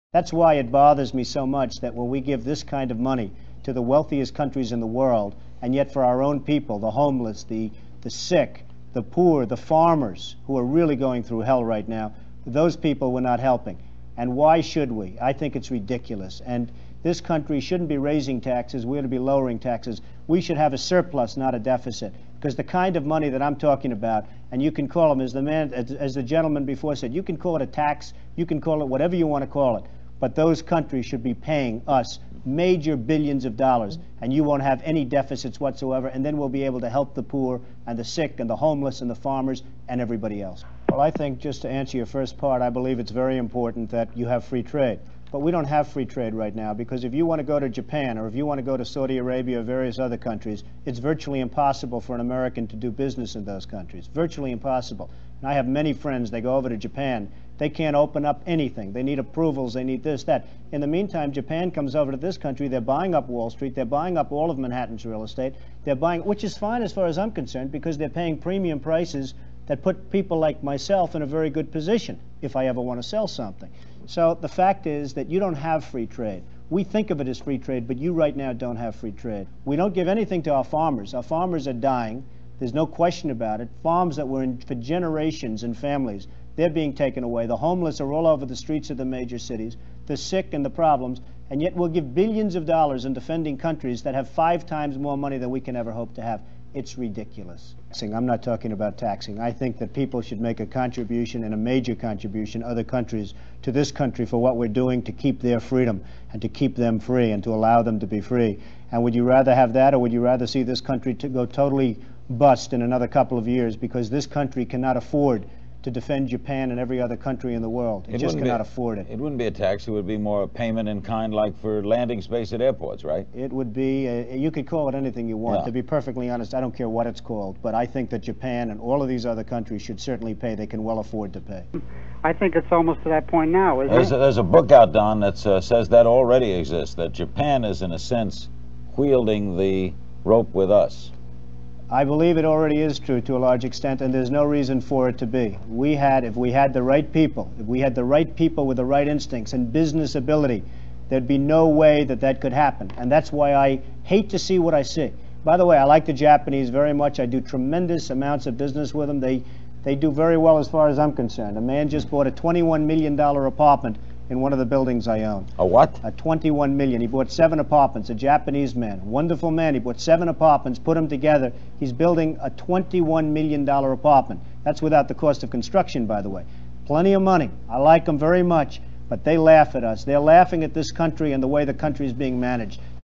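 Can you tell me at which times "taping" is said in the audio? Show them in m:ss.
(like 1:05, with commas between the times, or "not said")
not said.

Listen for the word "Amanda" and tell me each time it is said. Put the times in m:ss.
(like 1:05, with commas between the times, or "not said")
not said.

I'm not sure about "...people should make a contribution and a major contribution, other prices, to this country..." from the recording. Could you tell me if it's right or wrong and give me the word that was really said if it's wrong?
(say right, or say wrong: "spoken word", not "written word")
wrong: "countries", not "prices".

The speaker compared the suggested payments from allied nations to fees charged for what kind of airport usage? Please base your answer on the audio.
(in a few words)
landing space.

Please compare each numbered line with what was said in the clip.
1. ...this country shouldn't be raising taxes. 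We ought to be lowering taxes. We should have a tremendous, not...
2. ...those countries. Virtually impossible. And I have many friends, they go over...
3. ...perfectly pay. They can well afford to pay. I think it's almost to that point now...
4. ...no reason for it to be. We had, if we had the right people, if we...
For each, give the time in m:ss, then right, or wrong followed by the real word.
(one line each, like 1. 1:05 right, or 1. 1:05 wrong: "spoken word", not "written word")
1. 0:17 wrong: "surplus", not "tremendous"
2. 0:53 right
3. 2:09 wrong: "certainly", not "perfectly"
4. 2:24 right.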